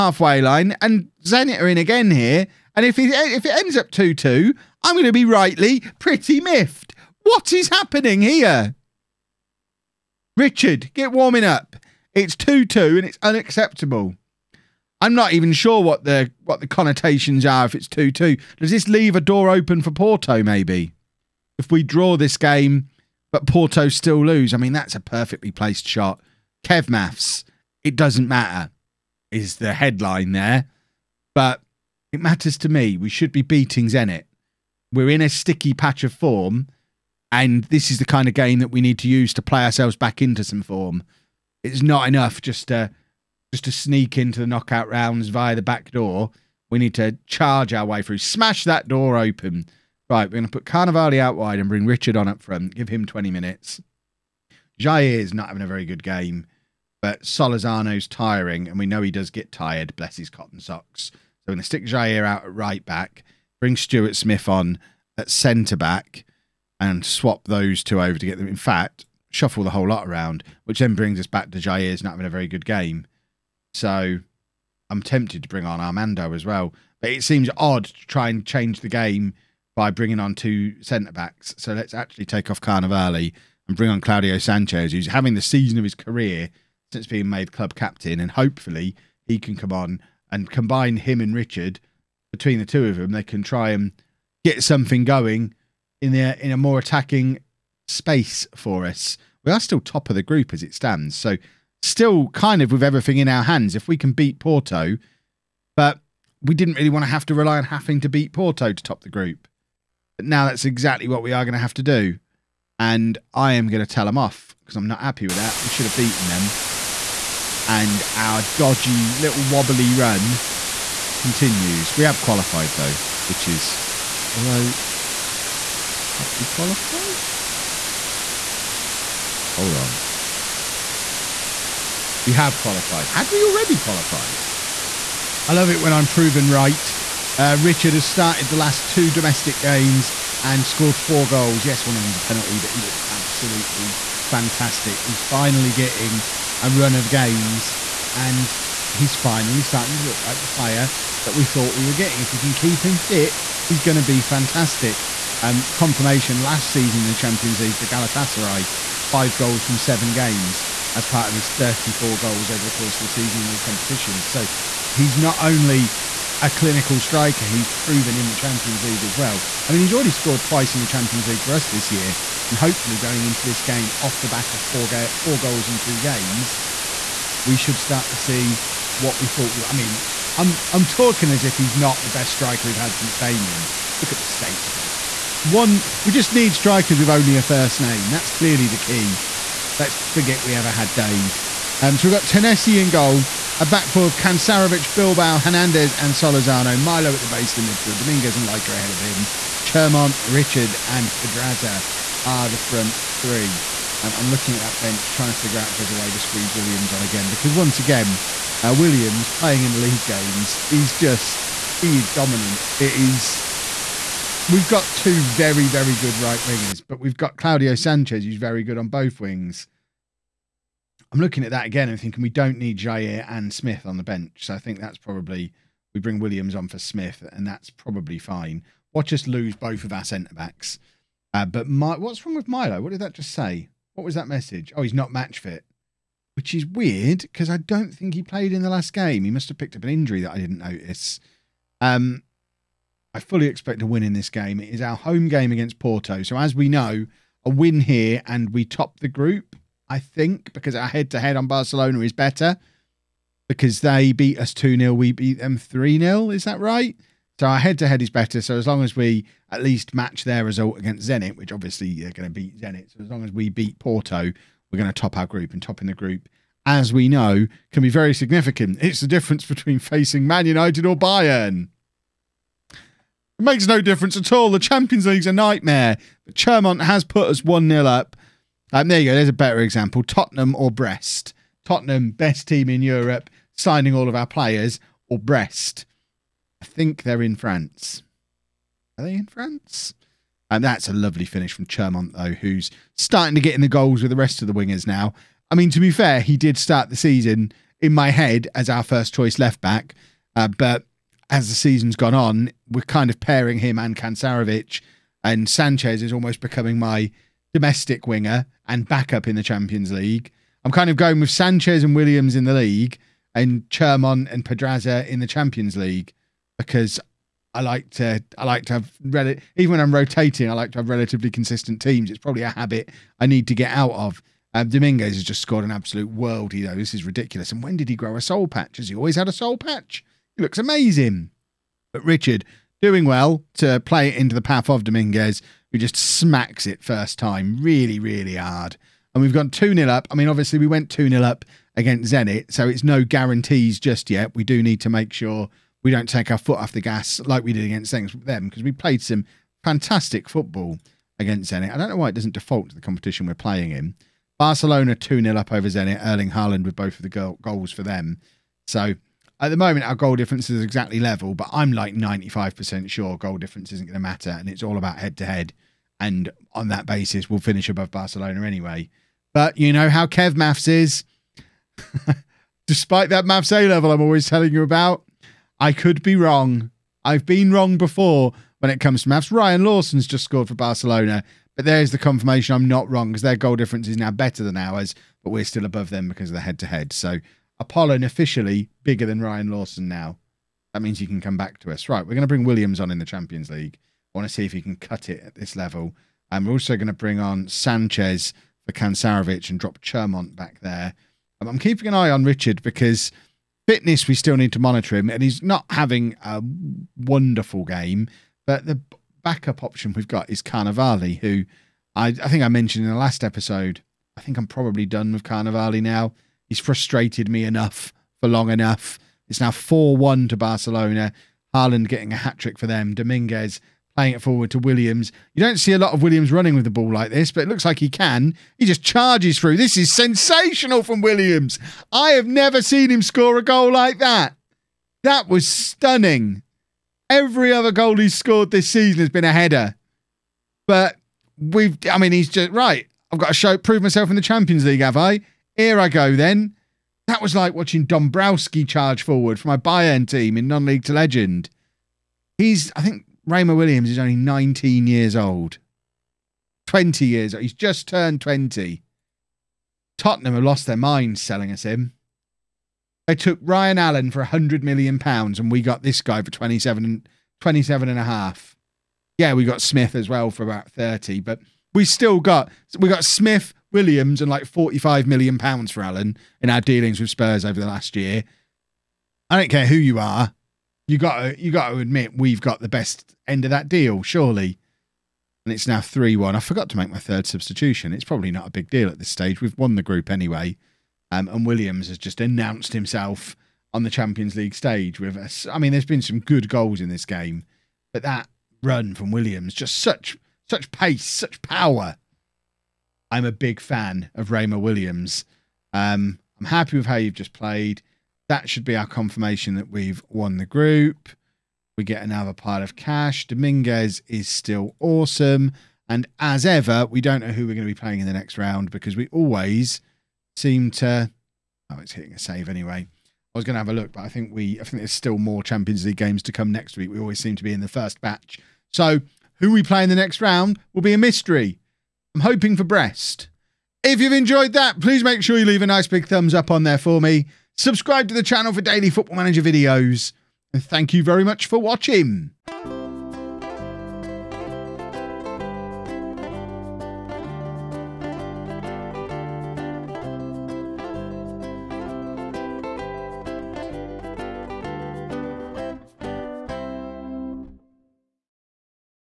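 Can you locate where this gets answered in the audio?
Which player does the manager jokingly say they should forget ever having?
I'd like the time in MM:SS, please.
03:10.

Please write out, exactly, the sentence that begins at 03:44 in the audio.
So I think that's probably we bring Williams on for Smith, and that's probably fine.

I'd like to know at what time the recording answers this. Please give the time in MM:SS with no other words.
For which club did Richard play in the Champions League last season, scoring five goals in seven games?
02:37.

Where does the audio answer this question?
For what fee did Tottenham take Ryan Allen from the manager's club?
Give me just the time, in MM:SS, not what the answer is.
07:44.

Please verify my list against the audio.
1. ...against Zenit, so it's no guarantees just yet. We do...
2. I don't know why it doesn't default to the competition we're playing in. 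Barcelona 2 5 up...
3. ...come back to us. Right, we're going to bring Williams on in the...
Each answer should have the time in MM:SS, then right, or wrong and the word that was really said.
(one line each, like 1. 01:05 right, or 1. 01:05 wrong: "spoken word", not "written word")
1. 05:41 right
2. 05:51 wrong: "0", not "5"
3. 06:31 right.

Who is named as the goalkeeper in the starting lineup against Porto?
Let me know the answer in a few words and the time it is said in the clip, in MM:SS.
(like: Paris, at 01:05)
Tennessee, at 03:12.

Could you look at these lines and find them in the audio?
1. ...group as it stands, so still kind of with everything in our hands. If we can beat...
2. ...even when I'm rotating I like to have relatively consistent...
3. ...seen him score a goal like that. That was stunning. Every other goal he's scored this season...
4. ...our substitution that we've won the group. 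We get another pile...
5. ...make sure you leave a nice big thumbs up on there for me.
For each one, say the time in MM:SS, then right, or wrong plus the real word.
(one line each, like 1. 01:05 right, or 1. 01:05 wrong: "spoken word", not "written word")
1. 01:40 right
2. 05:19 right
3. 07:12 right
4. 08:28 wrong: "confirmation", not "substitution"
5. 08:55 right.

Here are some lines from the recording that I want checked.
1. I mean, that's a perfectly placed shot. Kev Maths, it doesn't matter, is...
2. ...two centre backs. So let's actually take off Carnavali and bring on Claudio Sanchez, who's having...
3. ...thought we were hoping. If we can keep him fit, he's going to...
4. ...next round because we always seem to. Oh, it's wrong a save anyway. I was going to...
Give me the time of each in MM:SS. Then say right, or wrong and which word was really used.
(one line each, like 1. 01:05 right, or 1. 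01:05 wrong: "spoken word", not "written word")
1. 00:24 right
2. 01:20 right
3. 02:31 wrong: "getting", not "hoping"
4. 08:38 wrong: "hitting", not "wrong".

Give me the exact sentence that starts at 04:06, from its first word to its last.
So, as we know, a win here and we top the group.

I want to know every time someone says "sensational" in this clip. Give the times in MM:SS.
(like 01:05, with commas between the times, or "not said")
07:09.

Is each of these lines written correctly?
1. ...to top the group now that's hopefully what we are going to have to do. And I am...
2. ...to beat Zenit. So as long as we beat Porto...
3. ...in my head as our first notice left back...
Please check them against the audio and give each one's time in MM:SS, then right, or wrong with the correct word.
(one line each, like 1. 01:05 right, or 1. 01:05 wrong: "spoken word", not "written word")
1. 01:48 wrong: "exactly", not "hopefully"
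2. 04:22 right
3. 04:57 wrong: "choice", not "notice".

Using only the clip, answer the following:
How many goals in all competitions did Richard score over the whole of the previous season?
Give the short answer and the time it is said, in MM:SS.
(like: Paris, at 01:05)
34, at 02:41.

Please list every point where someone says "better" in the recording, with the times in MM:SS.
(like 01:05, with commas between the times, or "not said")
04:12, 04:18, 04:39, 06:24.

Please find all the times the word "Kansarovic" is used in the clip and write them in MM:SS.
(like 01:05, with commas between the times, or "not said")
03:14, 05:03, 06:38.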